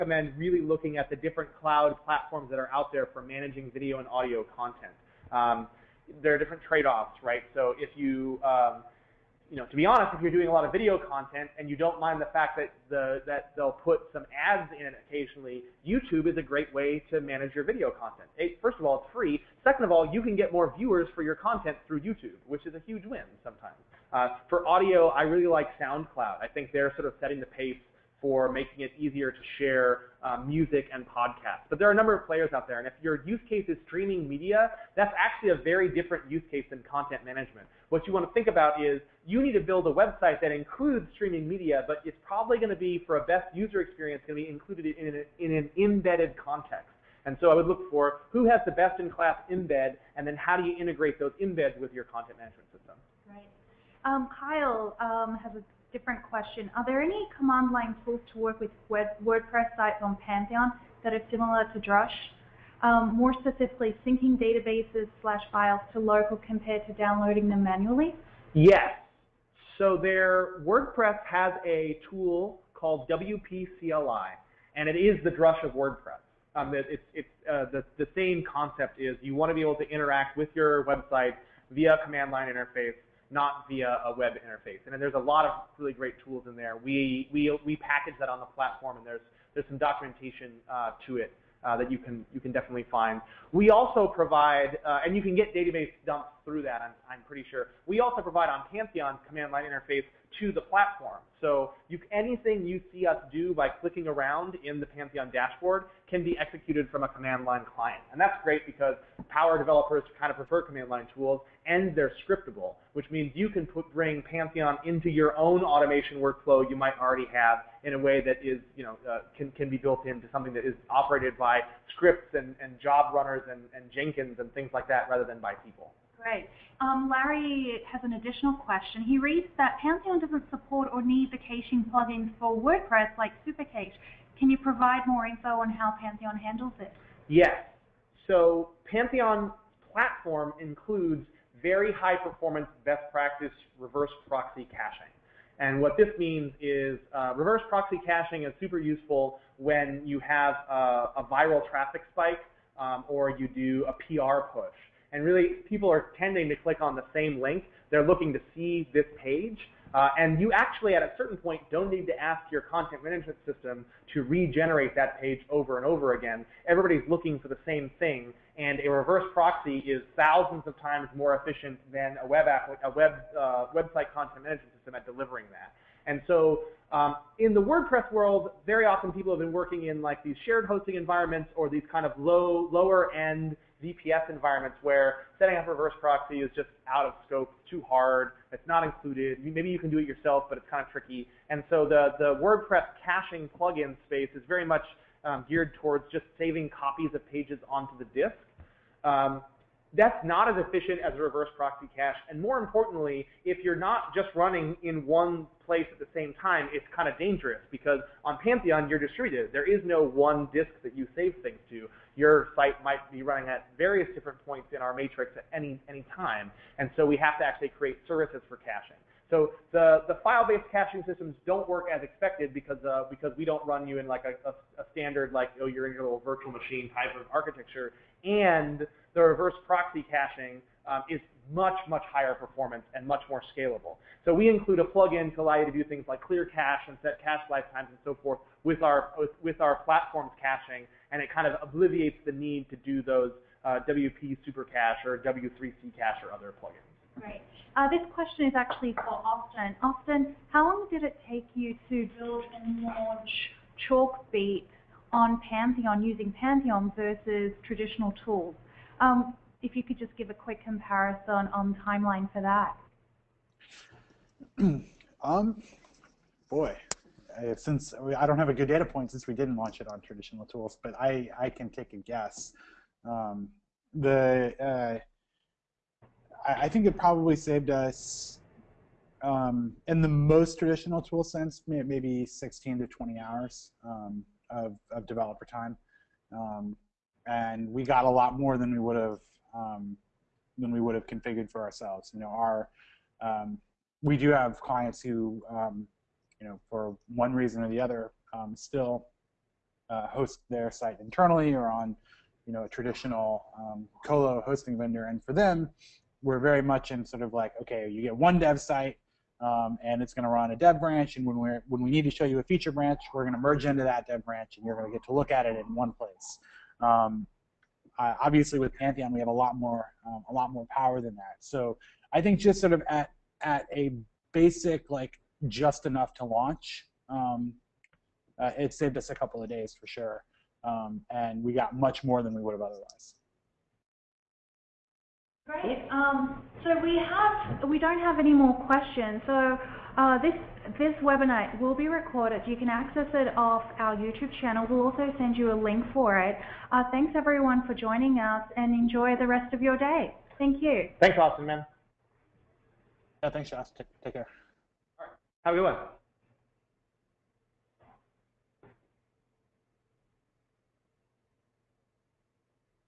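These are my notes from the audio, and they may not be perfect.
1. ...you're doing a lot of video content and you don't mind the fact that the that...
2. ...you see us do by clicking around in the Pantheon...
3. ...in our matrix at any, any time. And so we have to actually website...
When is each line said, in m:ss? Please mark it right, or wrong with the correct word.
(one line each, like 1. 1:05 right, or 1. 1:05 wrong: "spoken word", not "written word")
1. 0:10 right
2. 1:42 right
3. 3:34 wrong: "create", not "website".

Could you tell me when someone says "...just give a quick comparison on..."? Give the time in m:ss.
4:19.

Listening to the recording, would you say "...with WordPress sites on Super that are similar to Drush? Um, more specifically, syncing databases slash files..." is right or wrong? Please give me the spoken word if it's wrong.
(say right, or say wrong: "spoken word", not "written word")
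wrong: "Pantheon", not "Super".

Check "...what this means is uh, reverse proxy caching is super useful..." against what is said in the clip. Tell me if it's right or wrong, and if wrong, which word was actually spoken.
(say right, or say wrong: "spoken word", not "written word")
right.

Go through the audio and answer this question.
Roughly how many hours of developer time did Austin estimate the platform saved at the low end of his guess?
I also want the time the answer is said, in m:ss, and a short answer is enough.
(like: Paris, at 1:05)
16, at 4:42.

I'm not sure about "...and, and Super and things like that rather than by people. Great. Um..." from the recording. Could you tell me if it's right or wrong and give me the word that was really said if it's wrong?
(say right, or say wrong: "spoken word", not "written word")
wrong: "Jenkins", not "Super".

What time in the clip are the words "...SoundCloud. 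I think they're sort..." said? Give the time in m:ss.
0:25.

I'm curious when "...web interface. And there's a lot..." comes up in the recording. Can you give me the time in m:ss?
1:24.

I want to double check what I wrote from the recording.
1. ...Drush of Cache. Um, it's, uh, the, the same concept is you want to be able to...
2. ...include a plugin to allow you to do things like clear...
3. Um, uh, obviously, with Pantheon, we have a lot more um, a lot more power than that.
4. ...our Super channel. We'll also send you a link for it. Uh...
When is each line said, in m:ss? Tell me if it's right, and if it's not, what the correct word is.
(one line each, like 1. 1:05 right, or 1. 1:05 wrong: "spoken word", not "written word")
1. 1:15 wrong: "WordPress", not "Cache"
2. 3:54 right
3. 5:16 right
4. 5:43 wrong: "YouTube", not "Super".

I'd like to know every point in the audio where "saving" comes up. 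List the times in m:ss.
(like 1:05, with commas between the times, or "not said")
3:16.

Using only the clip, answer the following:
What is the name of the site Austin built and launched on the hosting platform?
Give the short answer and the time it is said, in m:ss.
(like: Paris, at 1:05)
Chalkbeat, at 4:13.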